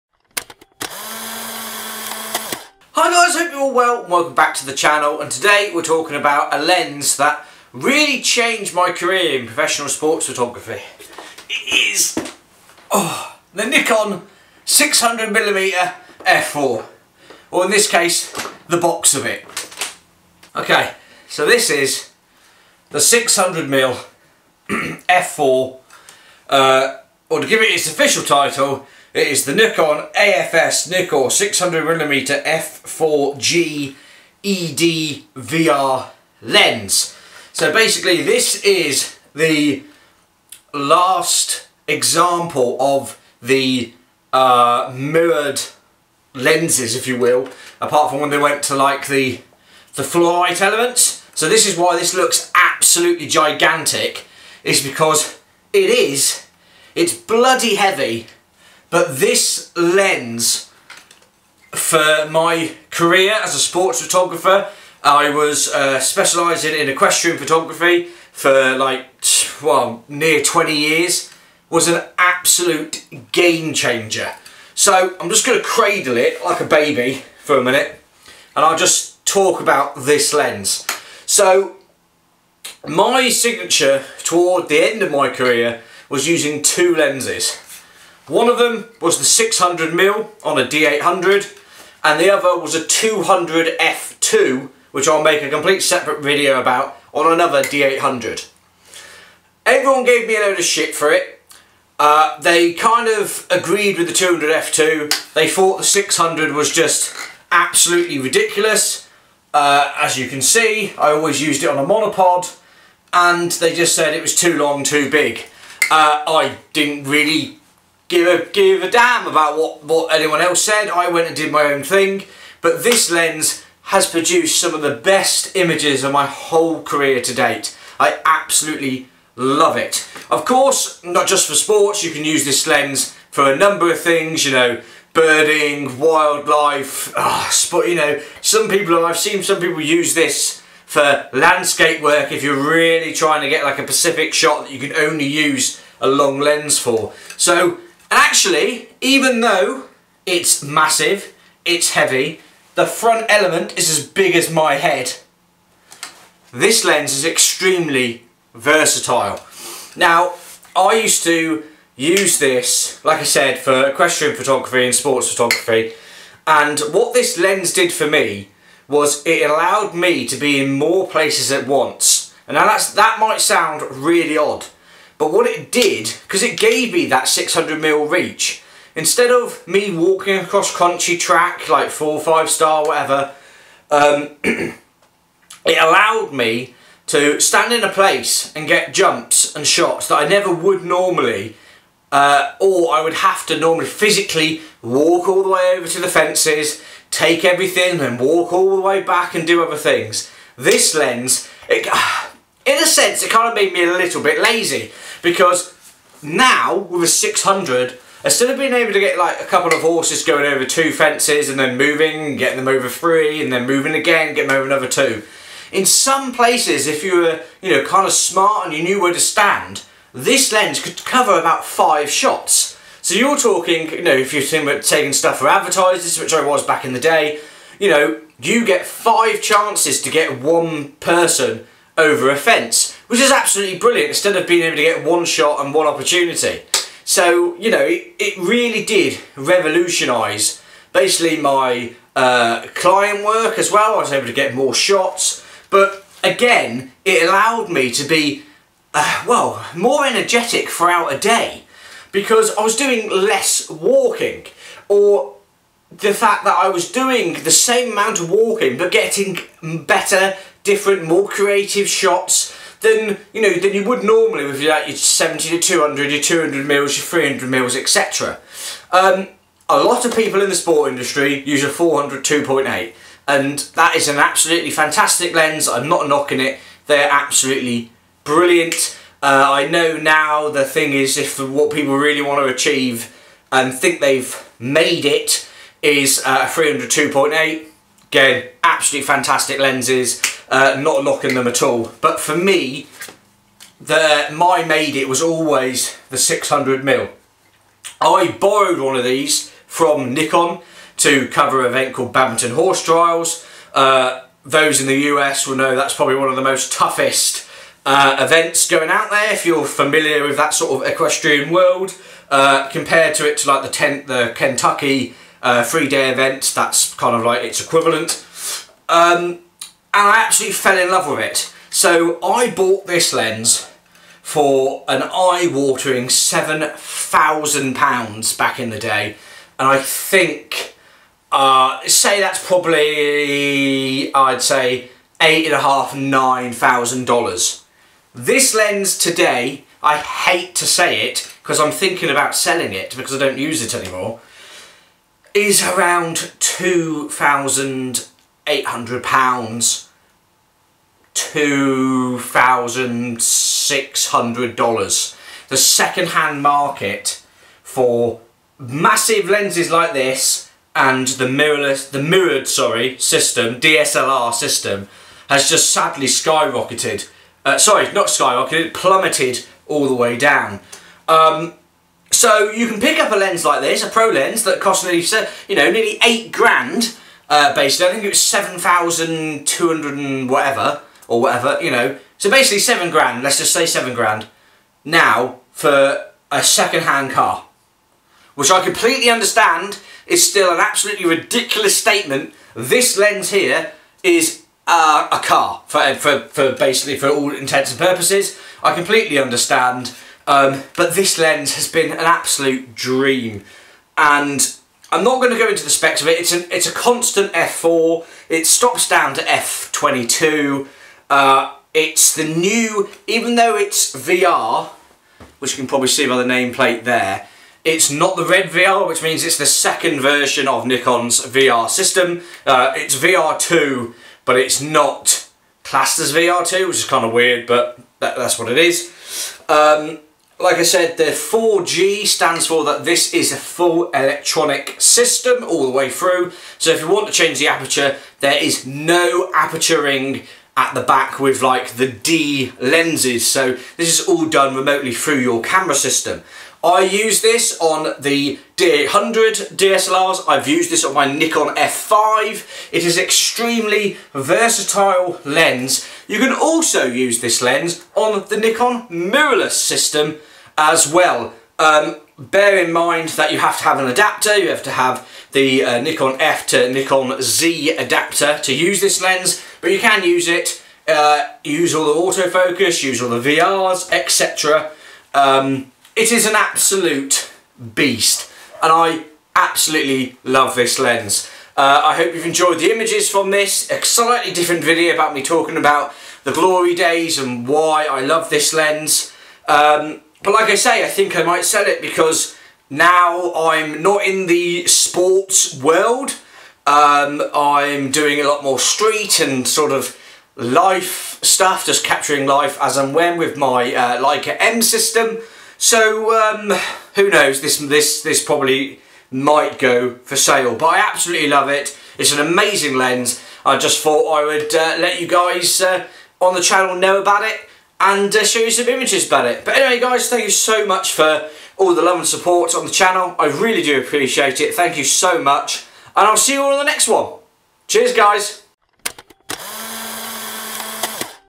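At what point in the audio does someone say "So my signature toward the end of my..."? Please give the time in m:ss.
1:21.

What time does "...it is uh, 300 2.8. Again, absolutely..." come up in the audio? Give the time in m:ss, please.
4:45.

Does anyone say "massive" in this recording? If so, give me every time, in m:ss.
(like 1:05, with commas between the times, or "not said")
2:30, 5:58.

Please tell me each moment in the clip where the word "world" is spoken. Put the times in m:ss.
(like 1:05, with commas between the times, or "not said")
5:11, 8:15.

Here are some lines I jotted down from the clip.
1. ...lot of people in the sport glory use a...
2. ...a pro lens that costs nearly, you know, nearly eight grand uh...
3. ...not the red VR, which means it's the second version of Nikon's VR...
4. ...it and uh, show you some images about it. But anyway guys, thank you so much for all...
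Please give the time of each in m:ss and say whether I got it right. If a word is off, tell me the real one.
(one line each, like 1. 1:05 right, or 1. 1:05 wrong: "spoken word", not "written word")
1. 4:29 wrong: "industry", not "glory"
2. 6:13 right
3. 6:57 right
4. 8:37 right.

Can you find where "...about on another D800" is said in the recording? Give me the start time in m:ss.
1:36.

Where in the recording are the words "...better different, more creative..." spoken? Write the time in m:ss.
4:19.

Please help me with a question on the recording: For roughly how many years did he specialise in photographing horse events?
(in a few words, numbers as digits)
20.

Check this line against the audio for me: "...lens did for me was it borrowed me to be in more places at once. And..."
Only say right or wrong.
wrong.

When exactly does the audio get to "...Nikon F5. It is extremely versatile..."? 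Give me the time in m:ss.
7:31.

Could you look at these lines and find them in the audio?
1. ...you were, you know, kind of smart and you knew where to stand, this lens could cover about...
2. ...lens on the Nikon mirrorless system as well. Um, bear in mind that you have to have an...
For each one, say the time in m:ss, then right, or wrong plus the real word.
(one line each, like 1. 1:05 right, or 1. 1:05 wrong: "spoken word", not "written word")
1. 3:37 right
2. 7:37 right.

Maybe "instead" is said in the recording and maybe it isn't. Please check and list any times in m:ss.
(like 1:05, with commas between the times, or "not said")
2:58, 3:28, 3:54.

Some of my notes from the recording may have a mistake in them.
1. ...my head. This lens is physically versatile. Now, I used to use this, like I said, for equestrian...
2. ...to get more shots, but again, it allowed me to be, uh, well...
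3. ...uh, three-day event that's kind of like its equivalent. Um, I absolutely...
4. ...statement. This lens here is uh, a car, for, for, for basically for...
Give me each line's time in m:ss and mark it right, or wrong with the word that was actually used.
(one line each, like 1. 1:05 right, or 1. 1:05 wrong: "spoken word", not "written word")
1. 2:34 wrong: "extremely", not "physically"
2. 4:04 right
3. 5:15 right
4. 6:31 right.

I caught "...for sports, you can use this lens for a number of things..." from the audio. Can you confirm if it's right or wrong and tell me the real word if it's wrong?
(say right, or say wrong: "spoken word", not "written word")
right.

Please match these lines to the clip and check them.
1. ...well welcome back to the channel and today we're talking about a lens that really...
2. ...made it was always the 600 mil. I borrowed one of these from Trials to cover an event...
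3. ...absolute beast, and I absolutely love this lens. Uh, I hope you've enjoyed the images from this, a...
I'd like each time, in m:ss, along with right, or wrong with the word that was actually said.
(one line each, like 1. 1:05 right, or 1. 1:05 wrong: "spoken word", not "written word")
1. 0:03 right
2. 4:54 wrong: "Nikon", not "Trials"
3. 7:56 right.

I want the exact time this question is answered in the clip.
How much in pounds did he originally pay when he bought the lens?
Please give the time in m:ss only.
5:26.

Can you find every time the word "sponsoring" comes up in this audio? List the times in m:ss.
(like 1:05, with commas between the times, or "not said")
not said.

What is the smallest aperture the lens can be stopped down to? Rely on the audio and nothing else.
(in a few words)
F22.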